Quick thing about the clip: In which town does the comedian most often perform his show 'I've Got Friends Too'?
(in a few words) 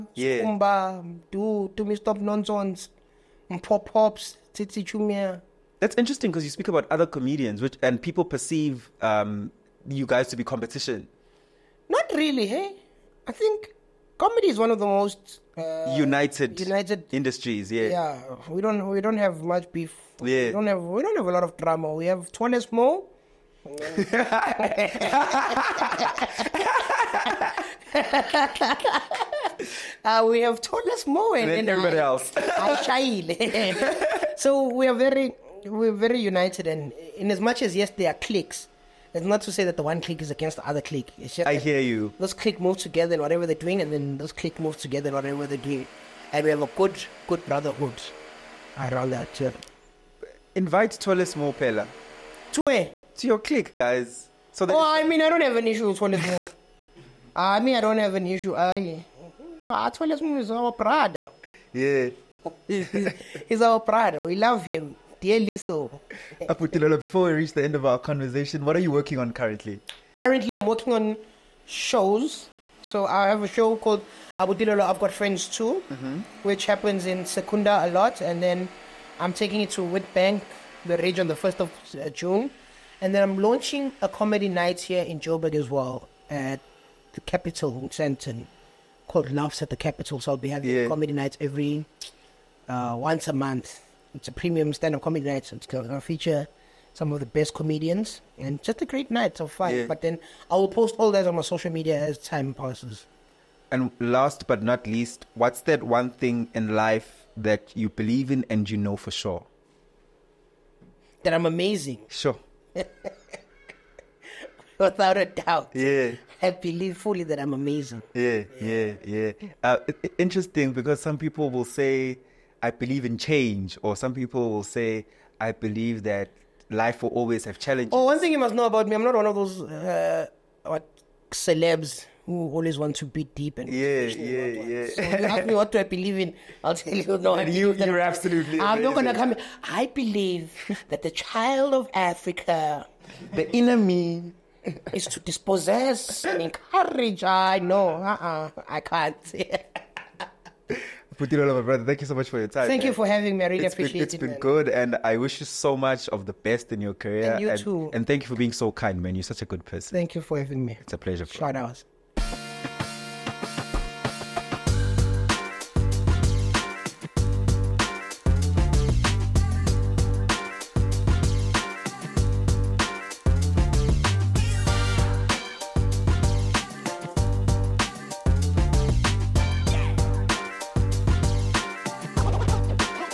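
Secunda.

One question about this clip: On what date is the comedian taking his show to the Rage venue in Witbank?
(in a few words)
1 June.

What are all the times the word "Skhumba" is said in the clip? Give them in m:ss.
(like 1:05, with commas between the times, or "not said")
0:00.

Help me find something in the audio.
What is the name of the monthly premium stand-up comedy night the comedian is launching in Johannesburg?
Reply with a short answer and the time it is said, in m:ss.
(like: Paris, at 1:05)
Laughs at the Capital, at 1:29.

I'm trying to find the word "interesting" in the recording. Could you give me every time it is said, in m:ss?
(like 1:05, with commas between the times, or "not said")
0:05, 2:00.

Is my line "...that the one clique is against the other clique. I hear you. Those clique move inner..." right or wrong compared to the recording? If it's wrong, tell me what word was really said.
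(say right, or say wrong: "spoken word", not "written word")
wrong: "together", not "inner".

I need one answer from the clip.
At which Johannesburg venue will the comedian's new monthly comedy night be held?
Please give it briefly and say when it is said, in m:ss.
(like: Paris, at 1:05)
Capital Centre, at 1:27.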